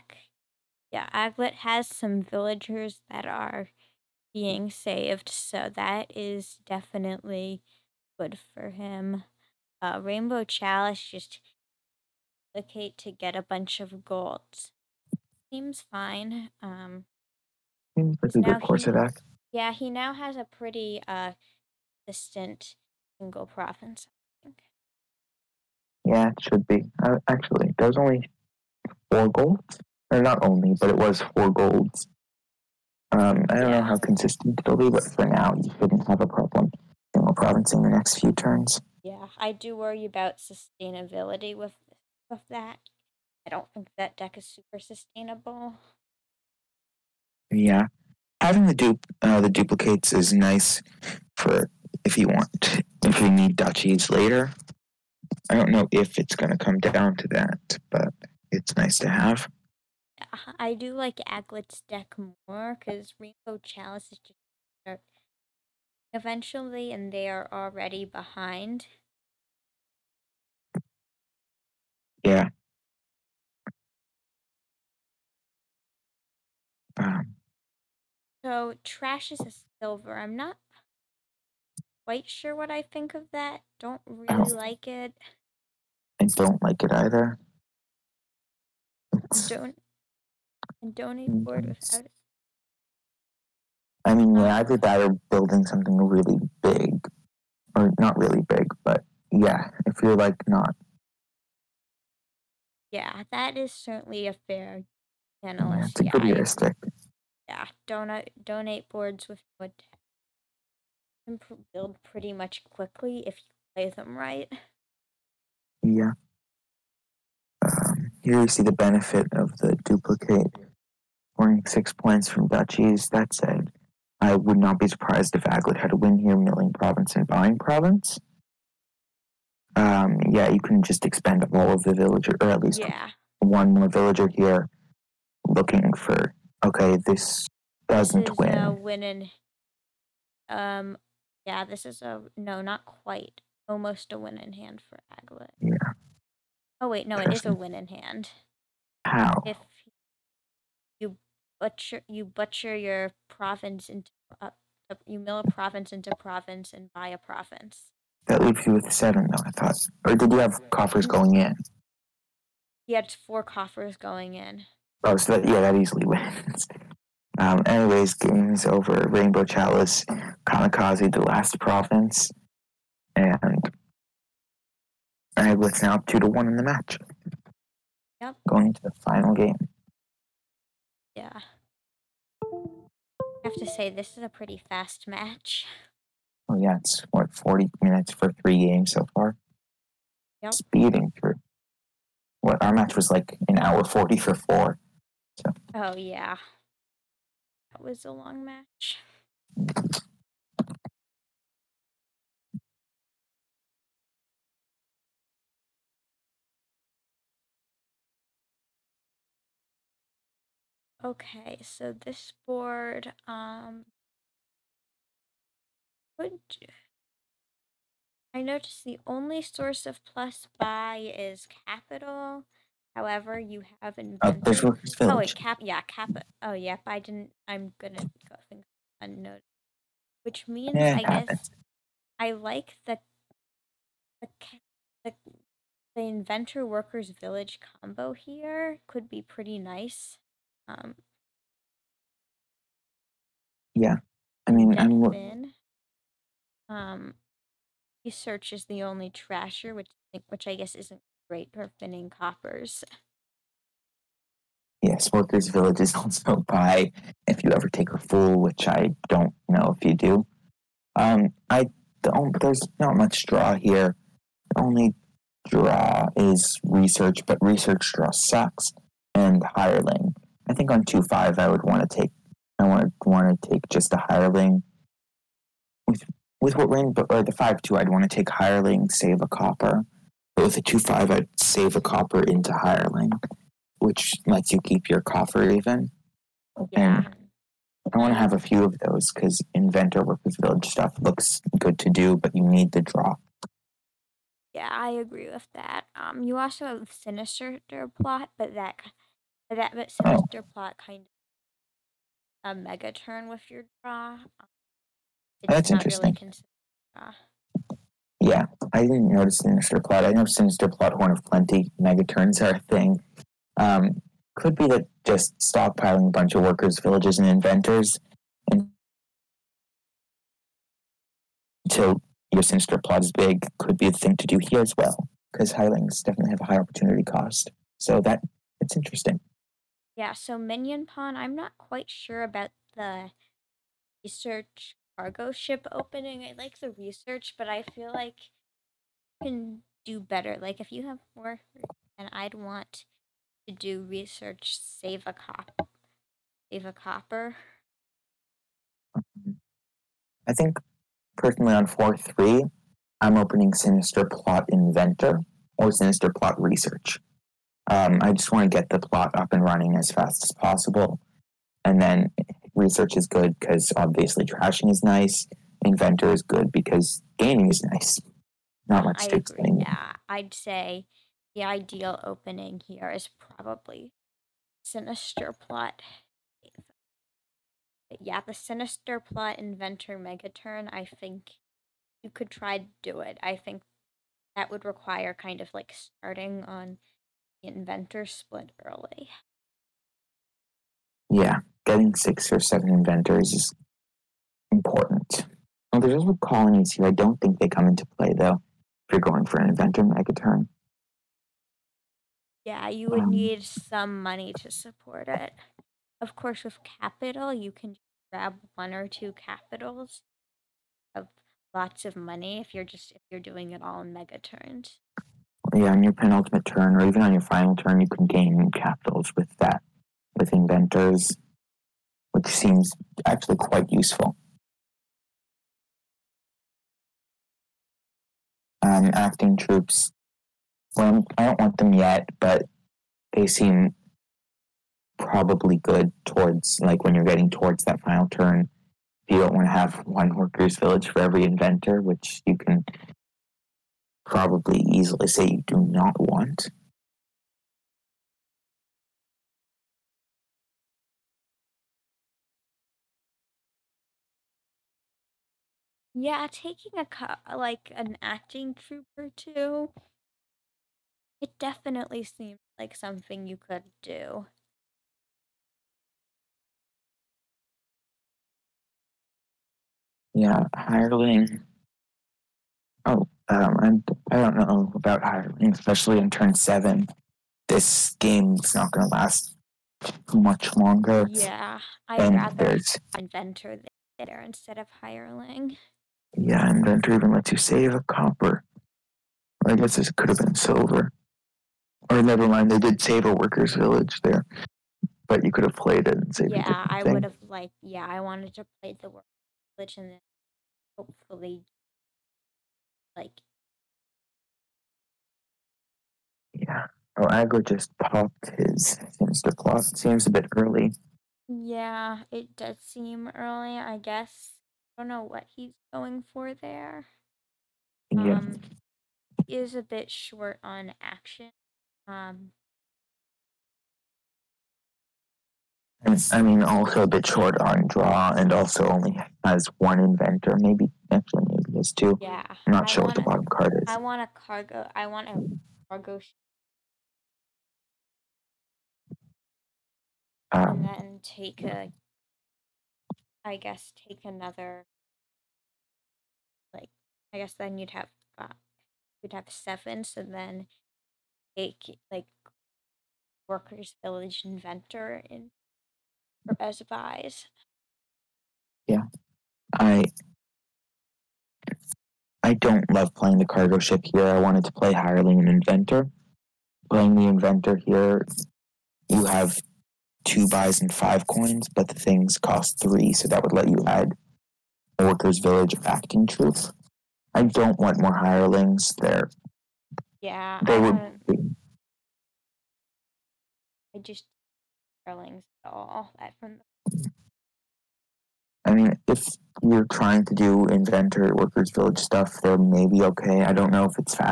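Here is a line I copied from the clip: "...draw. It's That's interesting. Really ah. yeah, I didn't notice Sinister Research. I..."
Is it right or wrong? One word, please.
wrong.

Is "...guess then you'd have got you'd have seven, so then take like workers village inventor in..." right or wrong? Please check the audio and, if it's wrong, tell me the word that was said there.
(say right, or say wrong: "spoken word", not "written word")
right.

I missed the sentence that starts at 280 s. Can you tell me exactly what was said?
But with a two five, I'd save a copper into hireling, which lets you keep your coffer even.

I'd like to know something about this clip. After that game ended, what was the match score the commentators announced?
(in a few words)
2 to 1.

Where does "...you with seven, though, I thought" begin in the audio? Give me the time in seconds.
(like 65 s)
158 s.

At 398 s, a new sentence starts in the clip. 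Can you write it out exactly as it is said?
If you're going for an inventor mega turn, Yeah, you would um, need some money to support it.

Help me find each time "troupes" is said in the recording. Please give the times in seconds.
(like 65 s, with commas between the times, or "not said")
429 s, 458 s, 576 s.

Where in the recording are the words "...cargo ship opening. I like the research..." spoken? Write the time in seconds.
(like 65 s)
334 s.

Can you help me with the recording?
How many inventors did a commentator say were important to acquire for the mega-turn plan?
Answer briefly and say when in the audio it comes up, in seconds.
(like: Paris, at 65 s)
6 or 7, at 391 s.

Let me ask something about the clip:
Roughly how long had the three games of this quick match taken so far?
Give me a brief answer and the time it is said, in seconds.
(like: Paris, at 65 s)
40 minutes, at 187 s.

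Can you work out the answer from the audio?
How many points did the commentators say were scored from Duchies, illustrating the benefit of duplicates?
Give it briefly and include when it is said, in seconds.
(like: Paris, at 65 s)
6, at 121 s.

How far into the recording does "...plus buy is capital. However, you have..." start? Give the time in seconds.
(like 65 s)
220 s.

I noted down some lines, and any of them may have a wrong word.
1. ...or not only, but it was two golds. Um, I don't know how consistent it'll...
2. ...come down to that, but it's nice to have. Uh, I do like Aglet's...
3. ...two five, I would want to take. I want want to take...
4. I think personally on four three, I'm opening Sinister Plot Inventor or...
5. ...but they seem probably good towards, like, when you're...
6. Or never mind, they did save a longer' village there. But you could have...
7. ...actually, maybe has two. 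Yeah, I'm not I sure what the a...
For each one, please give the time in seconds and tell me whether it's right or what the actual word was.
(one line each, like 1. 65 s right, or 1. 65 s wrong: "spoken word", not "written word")
1. 30 s wrong: "four", not "two"
2. 56 s right
3. 270 s right
4. 350 s right
5. 432 s right
6. 491 s wrong: "workers", not "longer"
7. 530 s right.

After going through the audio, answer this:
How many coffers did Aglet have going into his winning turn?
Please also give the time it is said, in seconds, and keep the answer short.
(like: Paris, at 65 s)
4, at 163 s.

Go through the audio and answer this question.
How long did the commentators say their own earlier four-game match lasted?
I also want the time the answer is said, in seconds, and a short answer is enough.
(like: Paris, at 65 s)
An hour forty, at 193 s.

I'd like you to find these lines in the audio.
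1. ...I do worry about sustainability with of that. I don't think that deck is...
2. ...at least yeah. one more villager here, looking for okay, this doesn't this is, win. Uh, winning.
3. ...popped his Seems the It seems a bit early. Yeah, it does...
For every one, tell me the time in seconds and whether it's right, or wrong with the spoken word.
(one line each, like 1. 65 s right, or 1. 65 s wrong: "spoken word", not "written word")
1. 39 s right
2. 132 s right
3. 507 s wrong: "Insta", not "Seems".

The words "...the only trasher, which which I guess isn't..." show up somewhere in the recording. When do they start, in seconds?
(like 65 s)
248 s.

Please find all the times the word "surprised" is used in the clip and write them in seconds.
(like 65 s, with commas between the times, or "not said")
124 s.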